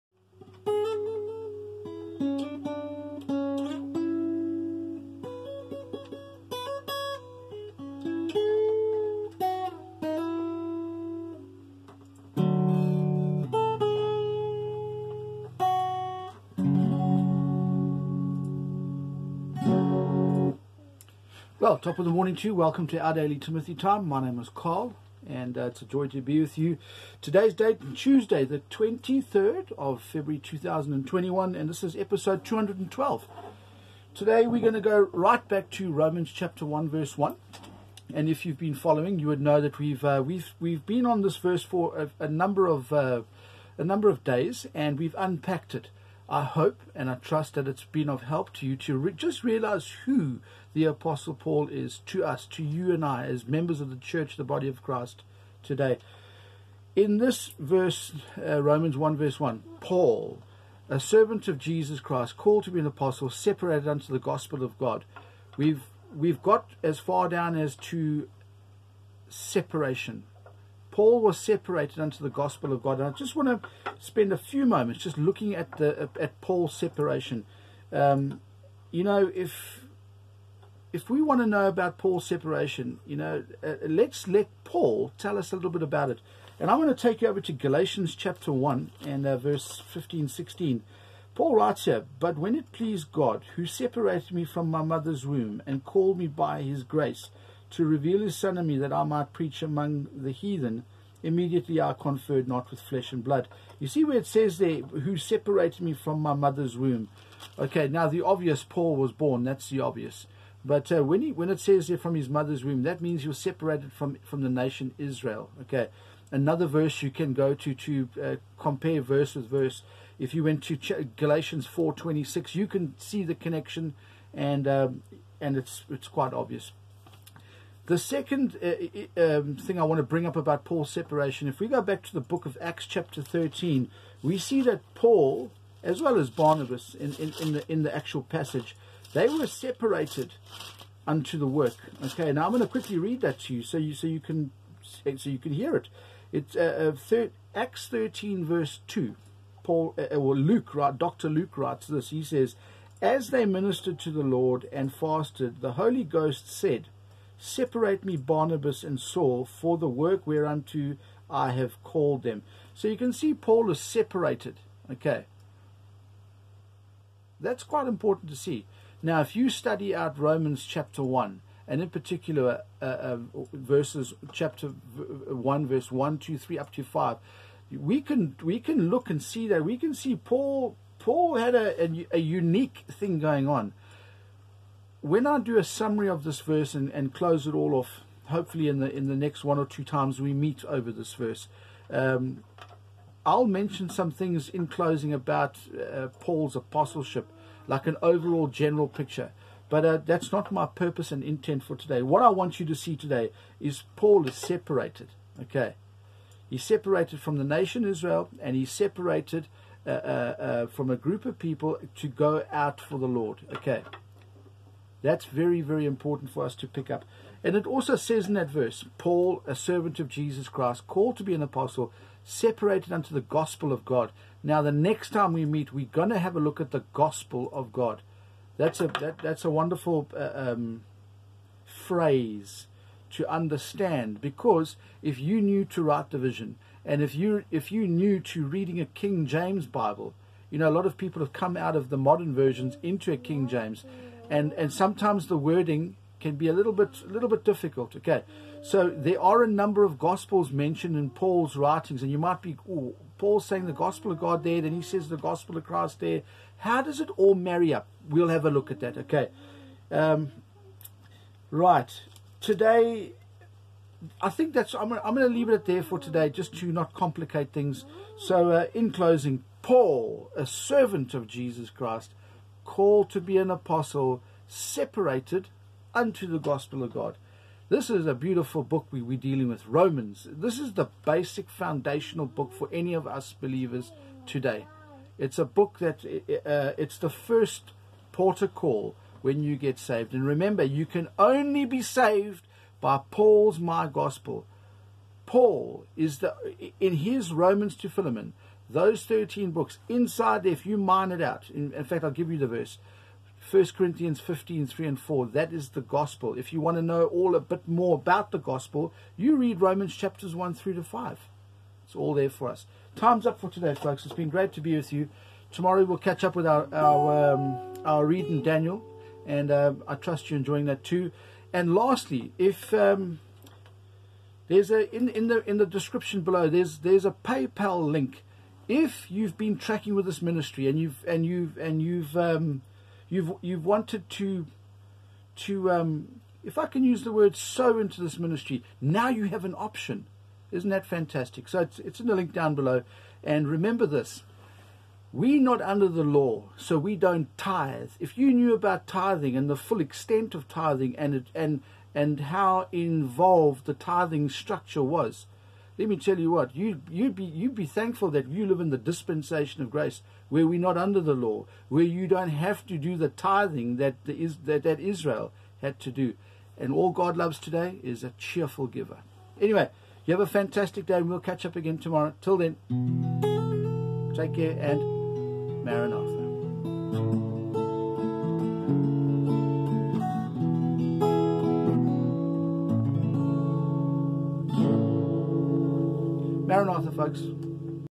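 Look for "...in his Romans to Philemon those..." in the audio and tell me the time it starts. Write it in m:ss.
4:56.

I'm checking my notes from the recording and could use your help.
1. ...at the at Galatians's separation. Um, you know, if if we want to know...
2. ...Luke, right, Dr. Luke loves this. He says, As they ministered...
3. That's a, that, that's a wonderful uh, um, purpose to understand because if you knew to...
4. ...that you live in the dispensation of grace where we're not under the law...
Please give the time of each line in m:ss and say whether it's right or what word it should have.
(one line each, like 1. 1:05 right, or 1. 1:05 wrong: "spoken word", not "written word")
1. 1:15 wrong: "Paul", not "Galatians"
2. 2:30 wrong: "writes", not "loves"
3. 3:48 wrong: "phrase", not "purpose"
4. 5:58 right.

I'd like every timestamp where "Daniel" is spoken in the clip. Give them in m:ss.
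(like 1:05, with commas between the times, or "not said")
5:18.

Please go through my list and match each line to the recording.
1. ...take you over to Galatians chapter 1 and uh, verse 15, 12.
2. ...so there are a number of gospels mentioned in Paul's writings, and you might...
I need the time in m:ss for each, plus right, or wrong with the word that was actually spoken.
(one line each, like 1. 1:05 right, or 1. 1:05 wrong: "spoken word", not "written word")
1. 1:27 wrong: "16", not "12"
2. 4:08 right.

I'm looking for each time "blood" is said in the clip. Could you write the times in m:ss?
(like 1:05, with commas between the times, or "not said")
1:43.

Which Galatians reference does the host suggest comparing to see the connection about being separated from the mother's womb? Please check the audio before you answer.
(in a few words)
Galatians 4:26.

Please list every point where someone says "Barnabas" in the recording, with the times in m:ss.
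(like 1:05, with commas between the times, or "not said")
2:16, 2:38.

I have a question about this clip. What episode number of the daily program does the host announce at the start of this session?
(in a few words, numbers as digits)
212.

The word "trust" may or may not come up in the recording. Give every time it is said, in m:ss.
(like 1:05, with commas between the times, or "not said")
0:47, 5:19.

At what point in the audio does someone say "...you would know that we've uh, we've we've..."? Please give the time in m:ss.
0:39.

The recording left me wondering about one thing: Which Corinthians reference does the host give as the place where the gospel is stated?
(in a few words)
1 Corinthians 15:3-4.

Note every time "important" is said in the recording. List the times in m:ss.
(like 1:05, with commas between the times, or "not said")
2:47, 3:35.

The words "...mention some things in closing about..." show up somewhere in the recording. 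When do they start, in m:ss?
3:13.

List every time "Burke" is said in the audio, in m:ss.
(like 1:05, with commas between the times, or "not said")
not said.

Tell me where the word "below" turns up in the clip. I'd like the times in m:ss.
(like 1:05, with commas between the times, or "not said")
5:26, 5:42.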